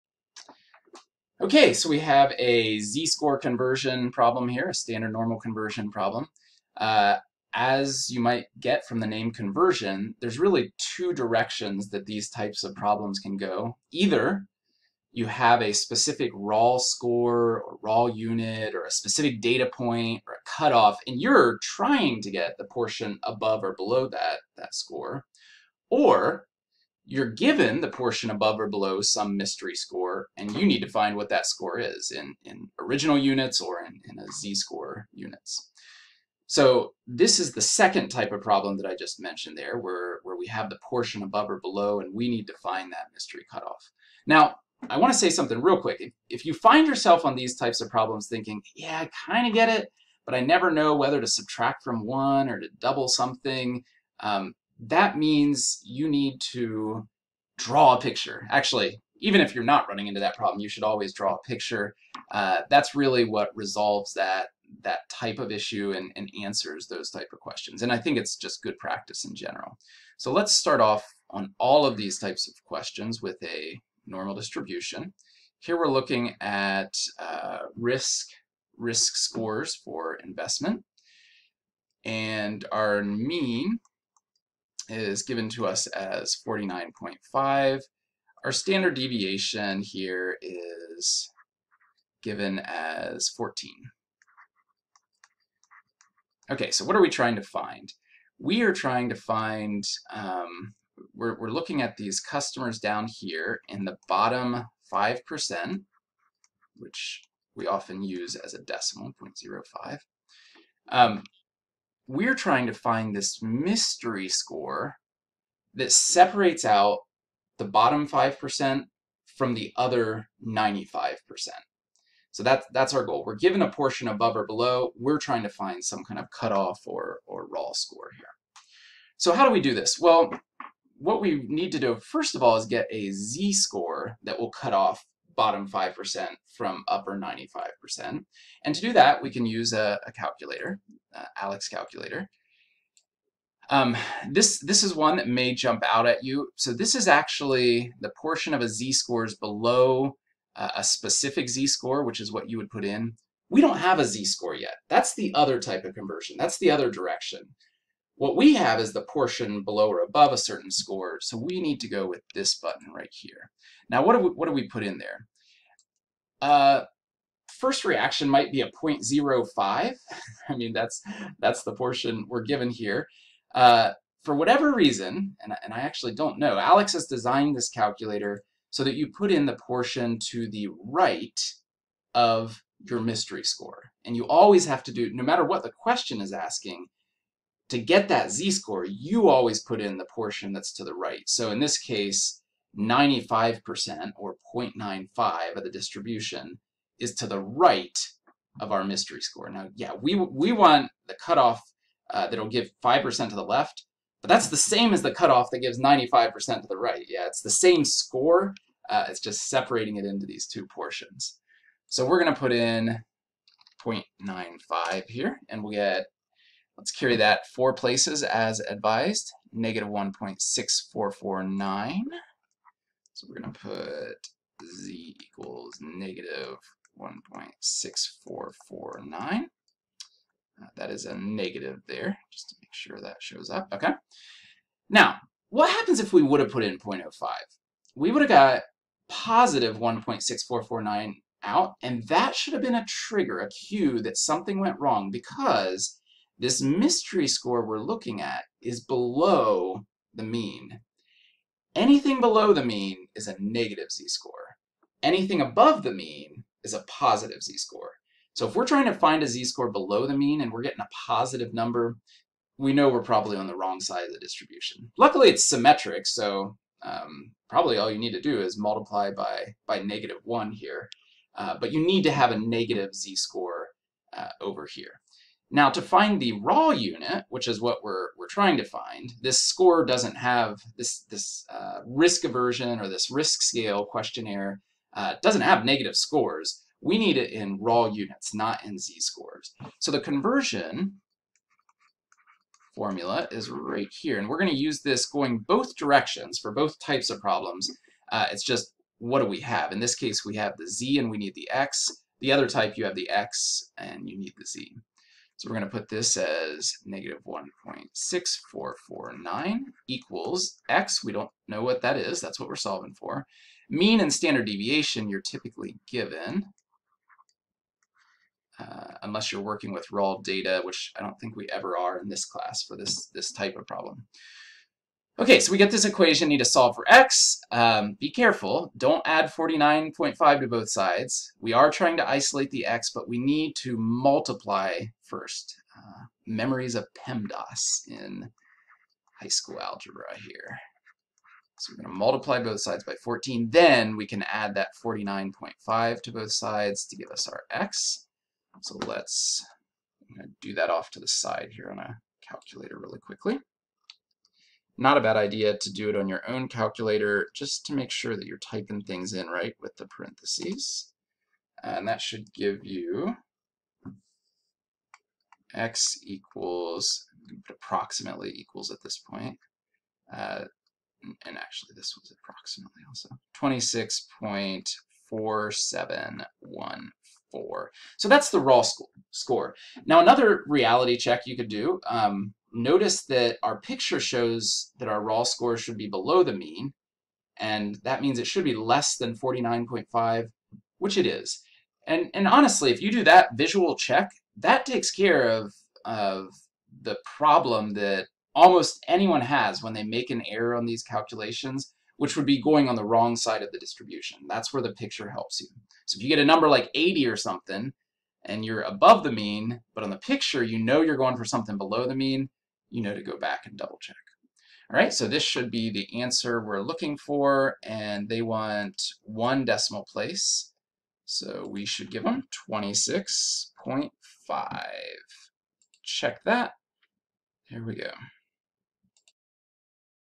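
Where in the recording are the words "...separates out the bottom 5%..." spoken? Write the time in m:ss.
1:55.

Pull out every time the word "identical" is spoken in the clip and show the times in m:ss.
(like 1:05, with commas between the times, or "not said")
not said.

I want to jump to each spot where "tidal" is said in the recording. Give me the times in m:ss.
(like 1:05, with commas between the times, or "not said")
not said.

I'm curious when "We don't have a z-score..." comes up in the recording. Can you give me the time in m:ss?
2:33.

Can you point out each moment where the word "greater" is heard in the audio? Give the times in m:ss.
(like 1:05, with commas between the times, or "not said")
not said.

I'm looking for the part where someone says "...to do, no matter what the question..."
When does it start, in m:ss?
3:04.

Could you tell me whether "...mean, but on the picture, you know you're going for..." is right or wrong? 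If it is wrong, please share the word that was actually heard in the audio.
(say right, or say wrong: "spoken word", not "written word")
right.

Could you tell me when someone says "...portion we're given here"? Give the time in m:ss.
2:51.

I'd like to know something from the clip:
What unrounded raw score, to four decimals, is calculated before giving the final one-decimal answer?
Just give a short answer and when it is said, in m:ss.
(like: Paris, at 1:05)
26.4714, at 6:13.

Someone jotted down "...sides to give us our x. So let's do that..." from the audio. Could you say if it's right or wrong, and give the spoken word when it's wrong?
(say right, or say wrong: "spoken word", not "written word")
right.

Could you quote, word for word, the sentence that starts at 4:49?
So the conversion formula is right here.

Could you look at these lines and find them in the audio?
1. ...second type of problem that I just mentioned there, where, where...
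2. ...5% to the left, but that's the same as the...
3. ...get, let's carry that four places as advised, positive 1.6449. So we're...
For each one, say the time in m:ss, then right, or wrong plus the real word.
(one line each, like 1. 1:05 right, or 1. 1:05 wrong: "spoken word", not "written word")
1. 0:37 right
2. 3:22 right
3. 3:35 wrong: "negative", not "positive".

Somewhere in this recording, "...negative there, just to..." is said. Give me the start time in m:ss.
3:51.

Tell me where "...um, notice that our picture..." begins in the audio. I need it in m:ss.
6:21.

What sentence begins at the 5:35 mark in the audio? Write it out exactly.
Uh, memories of PEMDAS in high school algebra here.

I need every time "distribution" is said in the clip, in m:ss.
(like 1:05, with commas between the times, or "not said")
1:14, 3:15, 4:24, 6:43.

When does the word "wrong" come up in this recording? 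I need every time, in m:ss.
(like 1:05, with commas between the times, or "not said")
4:04, 4:23, 6:42.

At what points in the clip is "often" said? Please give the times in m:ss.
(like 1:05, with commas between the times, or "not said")
1:47.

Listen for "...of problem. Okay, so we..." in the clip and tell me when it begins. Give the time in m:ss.
5:23.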